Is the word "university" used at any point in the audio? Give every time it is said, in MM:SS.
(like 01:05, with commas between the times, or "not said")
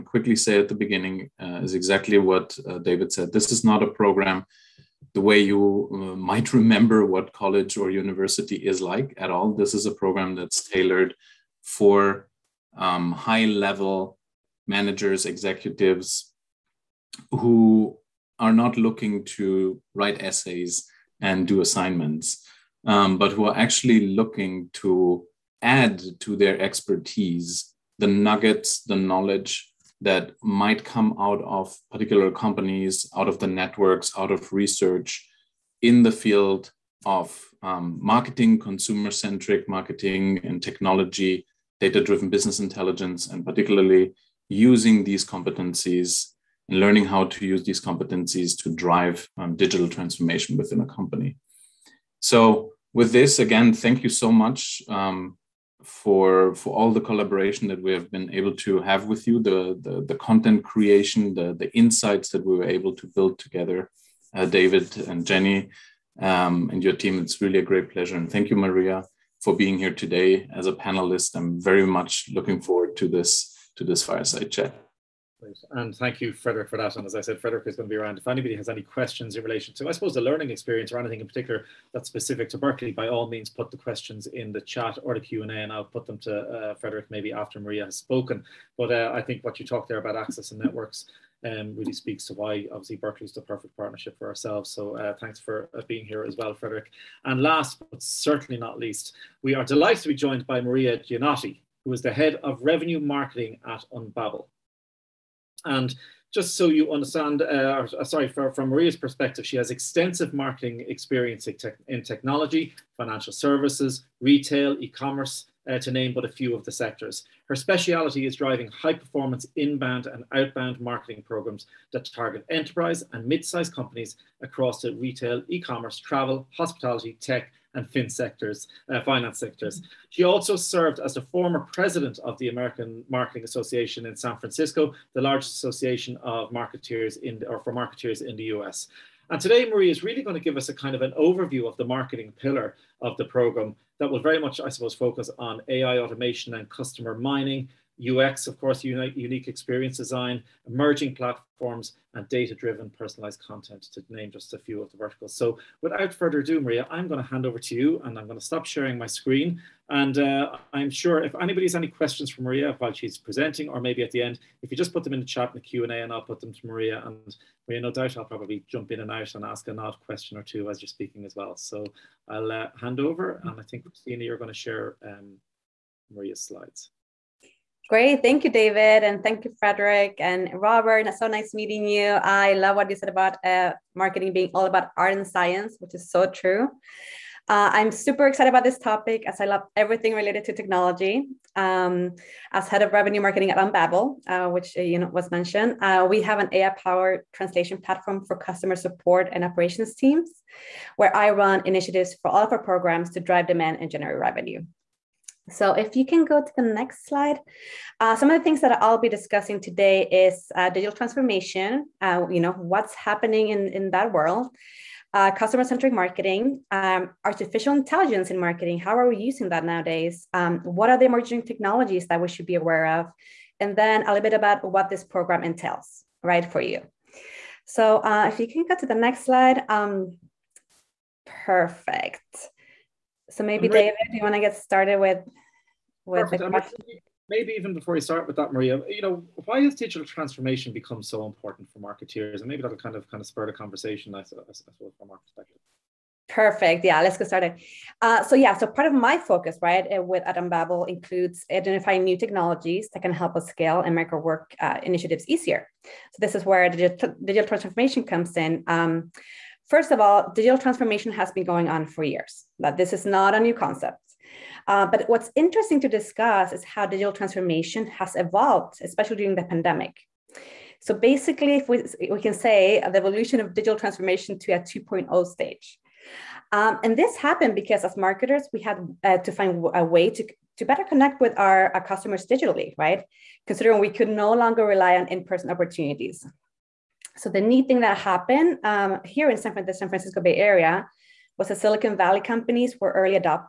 00:07.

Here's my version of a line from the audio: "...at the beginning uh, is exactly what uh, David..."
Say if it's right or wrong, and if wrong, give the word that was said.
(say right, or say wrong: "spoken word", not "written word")
right.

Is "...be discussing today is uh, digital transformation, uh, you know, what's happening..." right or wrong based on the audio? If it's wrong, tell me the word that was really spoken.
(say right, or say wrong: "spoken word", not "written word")
right.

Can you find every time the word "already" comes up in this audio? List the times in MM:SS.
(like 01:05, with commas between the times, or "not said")
not said.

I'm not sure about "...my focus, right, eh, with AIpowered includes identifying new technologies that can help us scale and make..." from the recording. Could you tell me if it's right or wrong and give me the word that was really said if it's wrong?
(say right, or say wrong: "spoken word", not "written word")
wrong: "Unbabel", not "AIpowered".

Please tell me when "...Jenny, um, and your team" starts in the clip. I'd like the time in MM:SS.
01:05.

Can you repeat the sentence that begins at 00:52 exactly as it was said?
So, with this, again, thank you so much.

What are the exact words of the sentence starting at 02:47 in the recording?
And Maria, no doubt I'll probably jump in and out and ask an odd question or two as you're speaking as well.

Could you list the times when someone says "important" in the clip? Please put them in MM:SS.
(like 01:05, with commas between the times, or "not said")
04:01.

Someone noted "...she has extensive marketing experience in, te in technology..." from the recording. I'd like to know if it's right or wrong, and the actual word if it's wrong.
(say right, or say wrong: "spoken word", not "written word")
right.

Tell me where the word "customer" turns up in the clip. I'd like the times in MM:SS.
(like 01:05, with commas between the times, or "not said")
02:26, 03:18, 03:35, 04:41.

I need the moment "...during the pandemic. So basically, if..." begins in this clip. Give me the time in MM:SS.
04:29.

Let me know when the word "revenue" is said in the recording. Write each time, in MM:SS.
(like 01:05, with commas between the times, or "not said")
01:42, 03:12, 03:24.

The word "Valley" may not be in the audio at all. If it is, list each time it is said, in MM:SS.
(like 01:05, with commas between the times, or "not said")
04:51.